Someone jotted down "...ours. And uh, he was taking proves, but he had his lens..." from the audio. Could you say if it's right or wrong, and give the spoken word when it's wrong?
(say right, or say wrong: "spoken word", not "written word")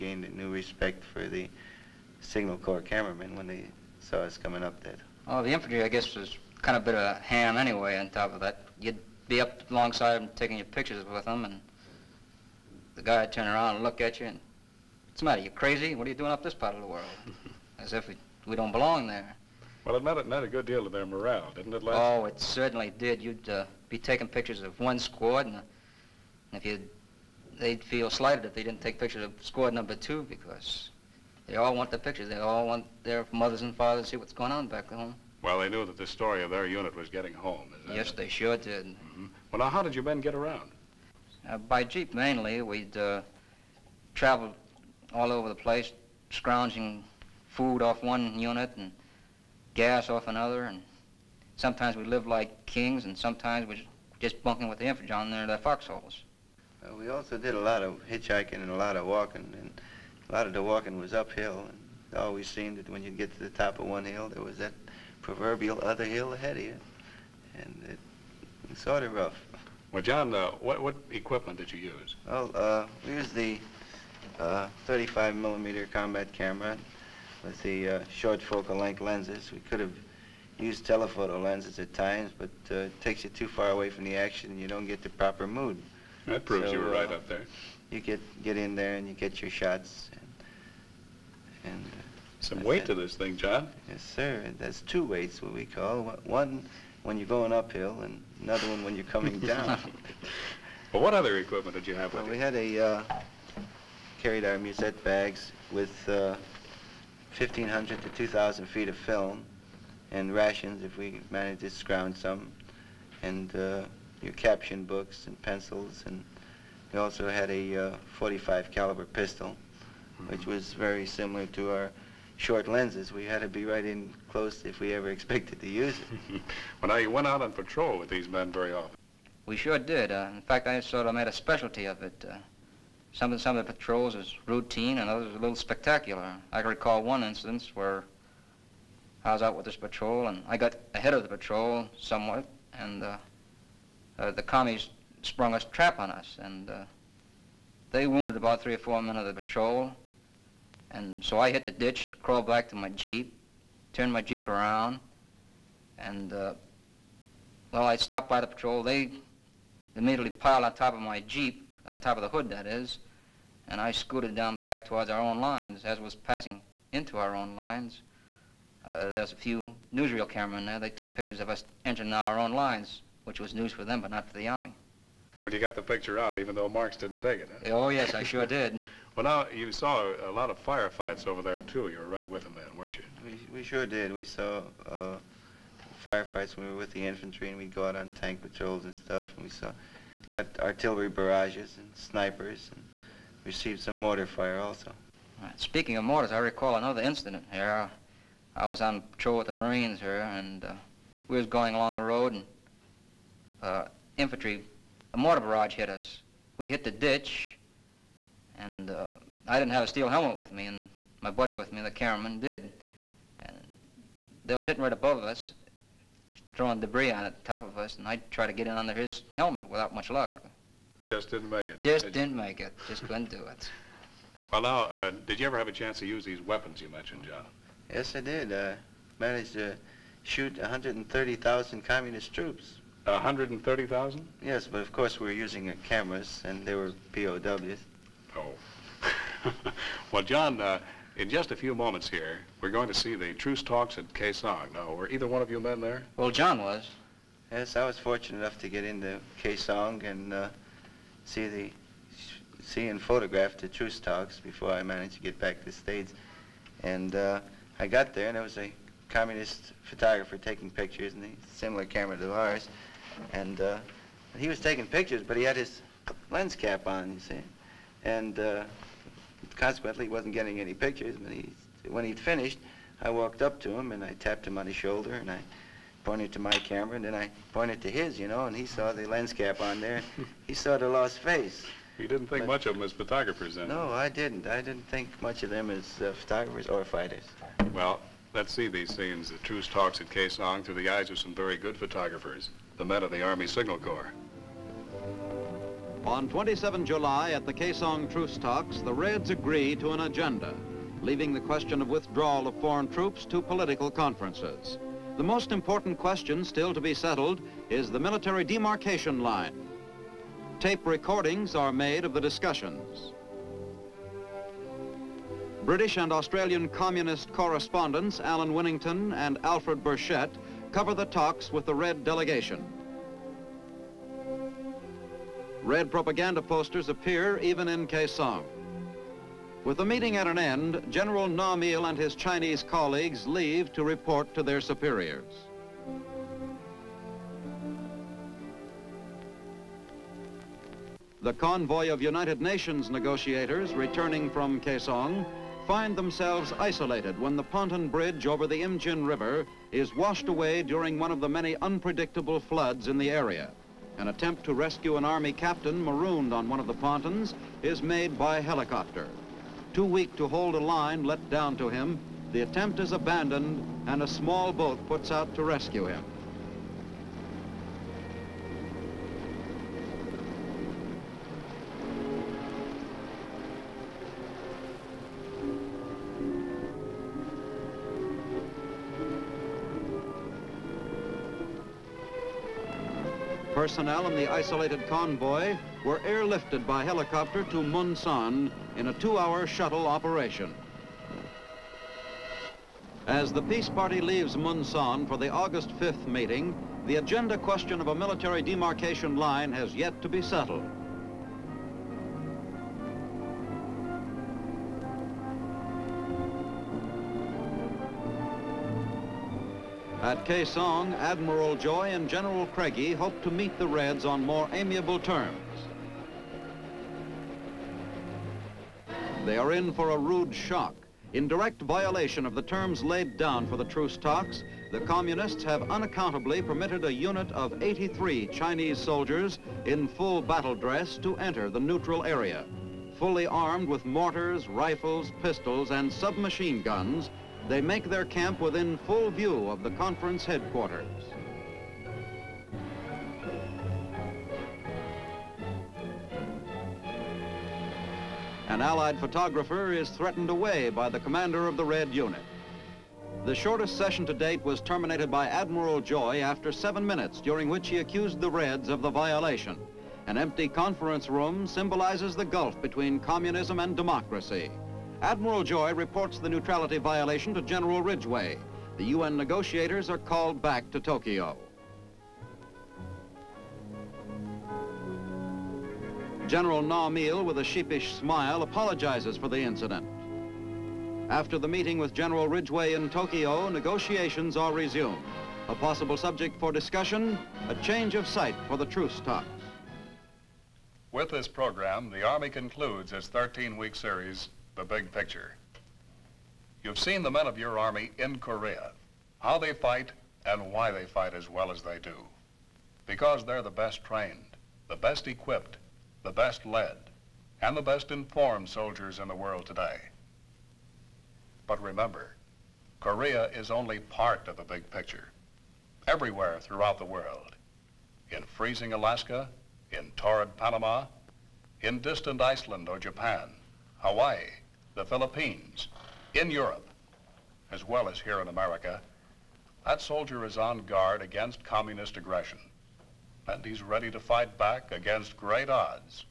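wrong: "pictures", not "proves".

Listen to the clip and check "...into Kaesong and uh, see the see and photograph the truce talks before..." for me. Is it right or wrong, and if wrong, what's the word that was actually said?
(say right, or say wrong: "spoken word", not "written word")
right.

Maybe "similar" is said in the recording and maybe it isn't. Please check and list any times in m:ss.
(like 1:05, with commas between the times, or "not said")
2:01, 4:21.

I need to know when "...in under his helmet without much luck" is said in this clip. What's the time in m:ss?
3:38.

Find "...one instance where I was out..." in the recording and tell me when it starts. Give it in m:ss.
2:17.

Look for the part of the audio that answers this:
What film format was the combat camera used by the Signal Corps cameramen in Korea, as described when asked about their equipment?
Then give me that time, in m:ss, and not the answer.
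1:14.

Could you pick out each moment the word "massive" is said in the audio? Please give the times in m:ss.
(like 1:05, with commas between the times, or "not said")
not said.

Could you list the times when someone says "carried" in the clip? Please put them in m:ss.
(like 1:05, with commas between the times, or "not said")
1:44.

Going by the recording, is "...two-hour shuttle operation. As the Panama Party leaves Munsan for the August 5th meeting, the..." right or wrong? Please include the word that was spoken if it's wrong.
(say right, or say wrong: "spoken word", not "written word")
wrong: "Peace", not "Panama".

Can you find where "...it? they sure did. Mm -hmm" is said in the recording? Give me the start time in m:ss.
0:38.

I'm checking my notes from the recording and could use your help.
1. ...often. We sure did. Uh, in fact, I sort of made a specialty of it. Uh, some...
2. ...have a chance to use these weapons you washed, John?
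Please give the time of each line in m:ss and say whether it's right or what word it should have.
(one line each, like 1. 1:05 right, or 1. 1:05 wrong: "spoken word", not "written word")
1. 2:08 right
2. 3:45 wrong: "mentioned", not "washed".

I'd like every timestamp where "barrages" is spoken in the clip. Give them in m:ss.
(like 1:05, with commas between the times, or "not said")
3:11, 3:25.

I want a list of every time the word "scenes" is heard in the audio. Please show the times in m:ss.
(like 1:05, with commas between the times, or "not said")
4:48.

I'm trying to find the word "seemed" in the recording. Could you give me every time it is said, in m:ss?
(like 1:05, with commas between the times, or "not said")
1:02.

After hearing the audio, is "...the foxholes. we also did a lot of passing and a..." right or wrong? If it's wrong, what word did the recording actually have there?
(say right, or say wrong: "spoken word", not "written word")
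wrong: "hitchhiking", not "passing".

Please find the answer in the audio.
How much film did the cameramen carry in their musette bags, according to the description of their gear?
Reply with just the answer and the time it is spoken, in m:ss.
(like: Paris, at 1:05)
1,500 to 2,000 feet, at 1:47.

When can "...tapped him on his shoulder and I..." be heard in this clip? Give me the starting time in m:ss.
4:34.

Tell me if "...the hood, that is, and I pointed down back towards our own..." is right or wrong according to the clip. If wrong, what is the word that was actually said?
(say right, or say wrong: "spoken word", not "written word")
wrong: "scooted", not "pointed".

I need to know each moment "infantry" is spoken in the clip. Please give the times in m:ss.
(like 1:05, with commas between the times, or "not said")
0:05, 0:54, 3:07, 3:24.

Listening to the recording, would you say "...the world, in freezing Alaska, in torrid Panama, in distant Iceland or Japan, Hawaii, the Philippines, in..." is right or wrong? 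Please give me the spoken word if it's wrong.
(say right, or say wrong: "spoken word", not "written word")
right.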